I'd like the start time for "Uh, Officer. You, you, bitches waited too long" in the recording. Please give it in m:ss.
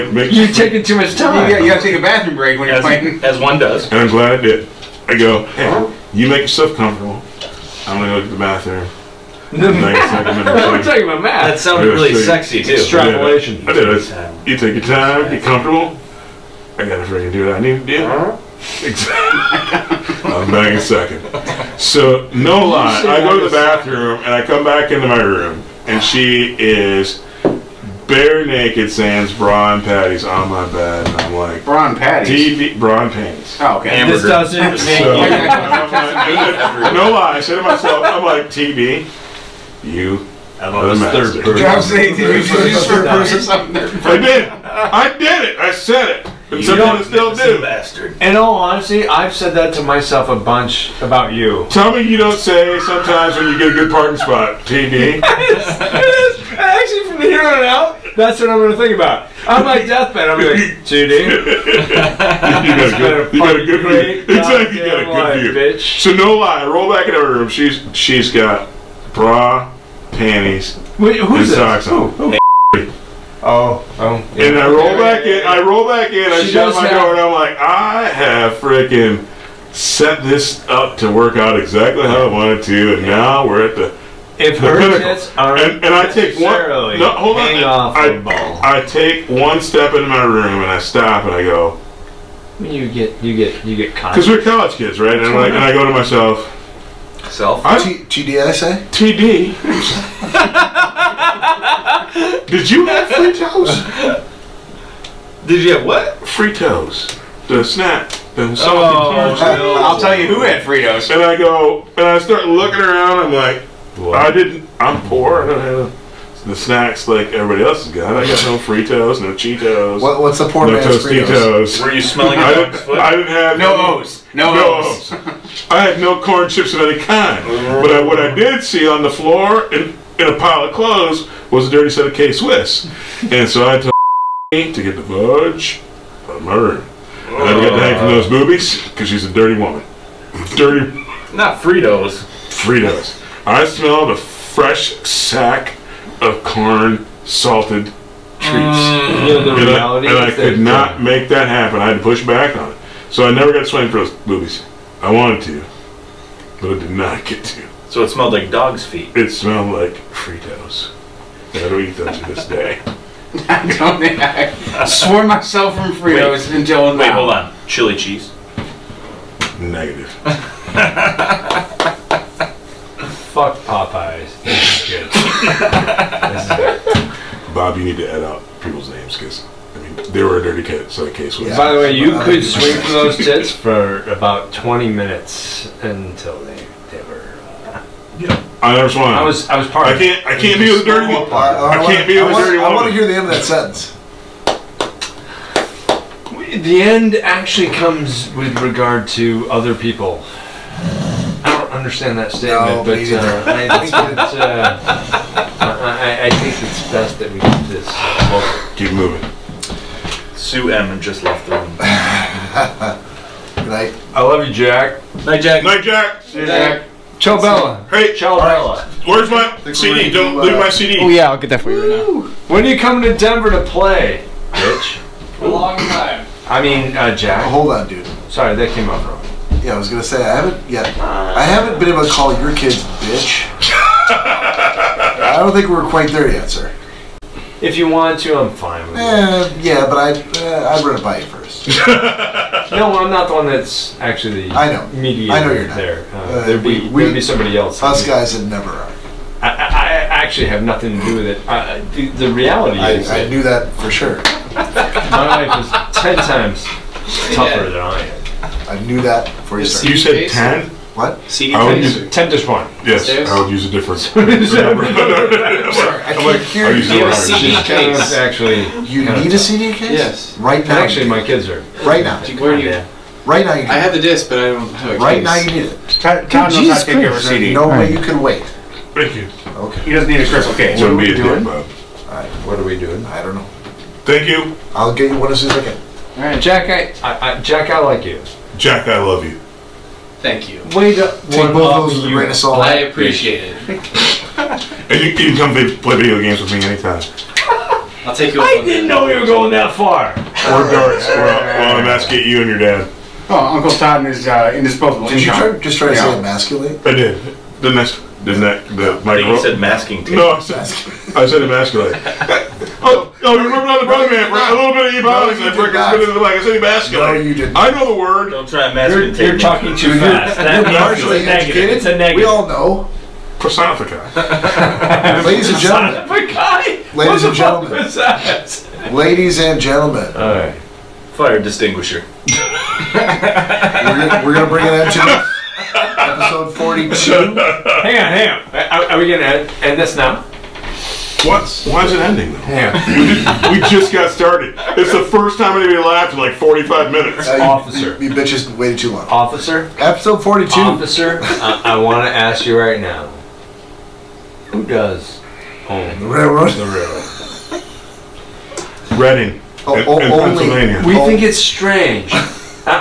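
5:47.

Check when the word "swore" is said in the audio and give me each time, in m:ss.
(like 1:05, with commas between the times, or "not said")
2:44.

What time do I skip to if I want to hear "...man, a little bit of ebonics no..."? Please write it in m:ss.
5:14.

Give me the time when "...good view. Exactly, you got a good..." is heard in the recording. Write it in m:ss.
1:03.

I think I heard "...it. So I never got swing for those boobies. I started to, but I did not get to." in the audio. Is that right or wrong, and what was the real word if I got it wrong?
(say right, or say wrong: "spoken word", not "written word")
wrong: "wanted", not "started".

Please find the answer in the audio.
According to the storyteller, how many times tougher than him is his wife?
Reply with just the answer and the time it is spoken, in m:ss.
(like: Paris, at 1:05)
10, at 4:16.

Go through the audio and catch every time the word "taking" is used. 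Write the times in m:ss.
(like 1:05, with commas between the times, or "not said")
0:00.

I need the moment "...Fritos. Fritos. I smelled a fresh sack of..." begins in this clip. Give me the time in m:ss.
2:21.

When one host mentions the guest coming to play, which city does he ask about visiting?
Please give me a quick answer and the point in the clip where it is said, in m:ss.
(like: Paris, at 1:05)
Denver, at 3:43.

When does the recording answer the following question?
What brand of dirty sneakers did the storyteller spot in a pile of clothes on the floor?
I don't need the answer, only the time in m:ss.
2:12.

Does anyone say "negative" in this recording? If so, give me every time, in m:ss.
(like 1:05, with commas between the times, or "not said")
2:49, 5:21.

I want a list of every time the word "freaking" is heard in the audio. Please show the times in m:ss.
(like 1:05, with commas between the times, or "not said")
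0:17, 1:18, 5:15.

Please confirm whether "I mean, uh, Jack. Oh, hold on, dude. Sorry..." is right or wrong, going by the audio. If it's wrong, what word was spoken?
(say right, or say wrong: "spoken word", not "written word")
right.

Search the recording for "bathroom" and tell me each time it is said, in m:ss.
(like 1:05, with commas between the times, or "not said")
0:02, 0:08, 0:23.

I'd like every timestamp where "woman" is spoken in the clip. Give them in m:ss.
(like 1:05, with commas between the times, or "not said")
2:19.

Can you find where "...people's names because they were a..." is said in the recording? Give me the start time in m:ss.
2:58.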